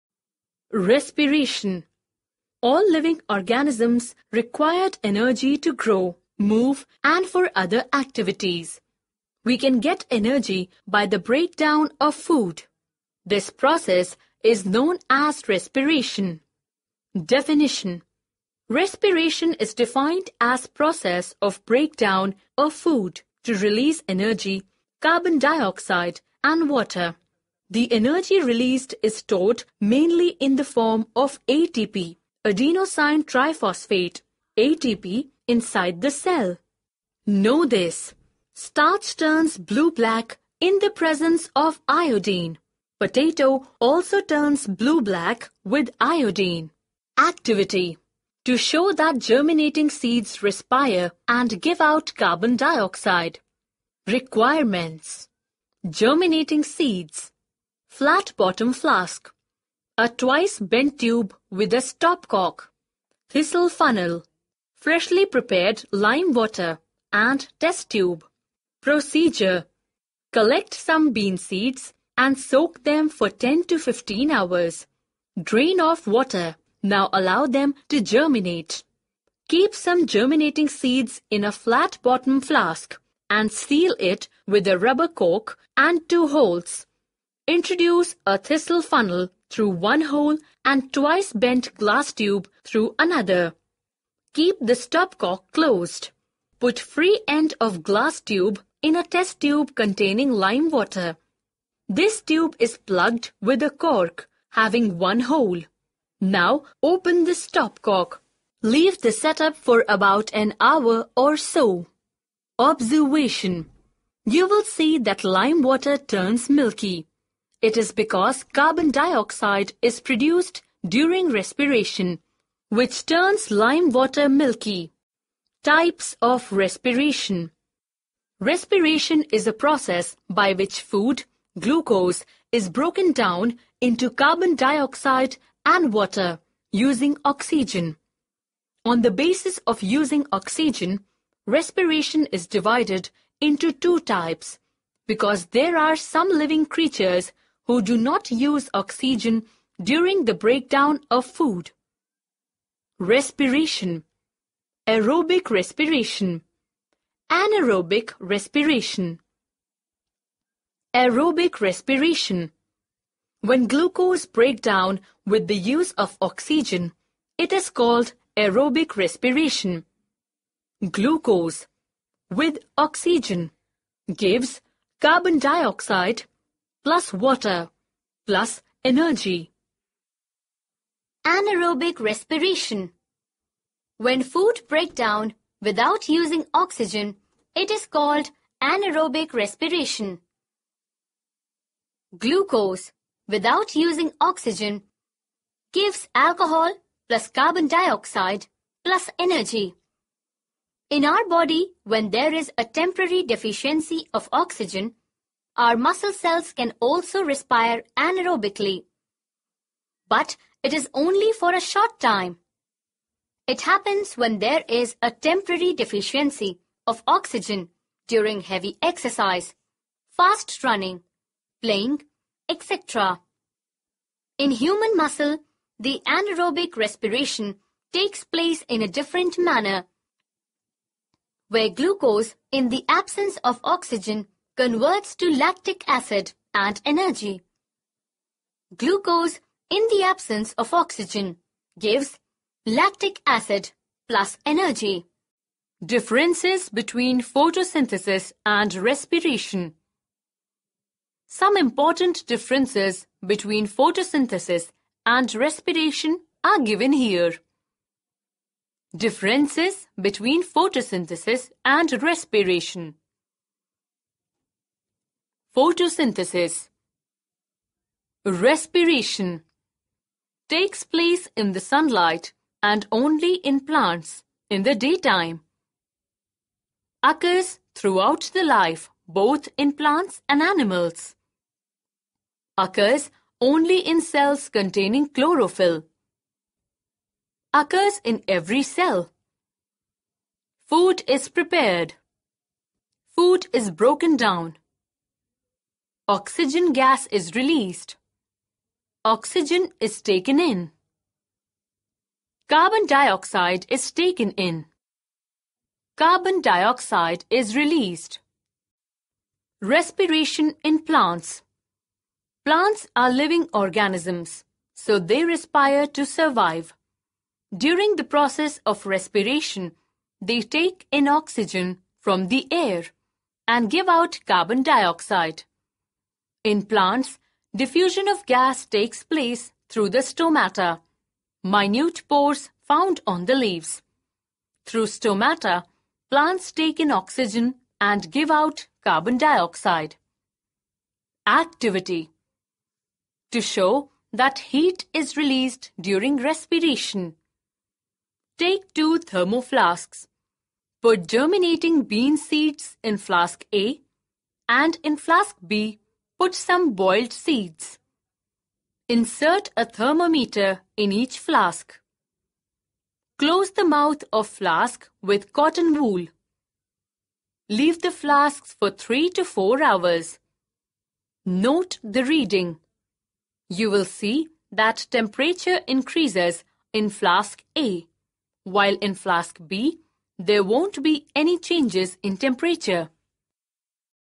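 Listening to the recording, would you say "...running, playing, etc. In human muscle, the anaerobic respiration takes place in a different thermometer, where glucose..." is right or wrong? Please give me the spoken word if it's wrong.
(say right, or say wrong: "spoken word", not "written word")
wrong: "manner", not "thermometer".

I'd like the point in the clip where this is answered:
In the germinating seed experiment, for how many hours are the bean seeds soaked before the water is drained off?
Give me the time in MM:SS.
01:13.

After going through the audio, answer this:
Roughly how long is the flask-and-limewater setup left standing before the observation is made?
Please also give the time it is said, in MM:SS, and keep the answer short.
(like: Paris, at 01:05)
about an hour, at 01:49.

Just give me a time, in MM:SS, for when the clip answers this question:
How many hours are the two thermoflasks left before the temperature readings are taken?
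06:08.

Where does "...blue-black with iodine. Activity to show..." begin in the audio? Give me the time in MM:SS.
00:44.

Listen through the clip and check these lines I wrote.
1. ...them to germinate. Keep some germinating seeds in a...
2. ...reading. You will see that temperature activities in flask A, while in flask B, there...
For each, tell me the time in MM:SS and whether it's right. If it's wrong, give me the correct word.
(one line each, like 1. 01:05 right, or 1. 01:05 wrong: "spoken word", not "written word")
1. 01:17 right
2. 06:12 wrong: "increases", not "activities".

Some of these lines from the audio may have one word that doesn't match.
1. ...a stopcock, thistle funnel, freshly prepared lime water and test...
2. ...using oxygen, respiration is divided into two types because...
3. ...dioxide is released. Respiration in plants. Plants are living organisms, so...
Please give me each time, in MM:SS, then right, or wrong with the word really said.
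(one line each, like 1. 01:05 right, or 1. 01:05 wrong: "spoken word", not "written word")
1. 01:01 right
2. 02:19 right
3. 05:06 right.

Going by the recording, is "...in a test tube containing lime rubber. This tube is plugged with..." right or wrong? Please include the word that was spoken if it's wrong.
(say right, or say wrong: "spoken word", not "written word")
wrong: "water", not "rubber".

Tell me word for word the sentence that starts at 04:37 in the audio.
Occurs throughout the life both in plants and animals.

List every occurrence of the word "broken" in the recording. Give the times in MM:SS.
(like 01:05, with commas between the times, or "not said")
02:12, 04:53.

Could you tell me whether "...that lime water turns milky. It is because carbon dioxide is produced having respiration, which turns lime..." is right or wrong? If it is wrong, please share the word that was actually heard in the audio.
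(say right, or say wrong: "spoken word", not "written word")
wrong: "during", not "having".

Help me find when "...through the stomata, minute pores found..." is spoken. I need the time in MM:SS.
05:29.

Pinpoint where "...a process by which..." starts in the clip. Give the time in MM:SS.
02:09.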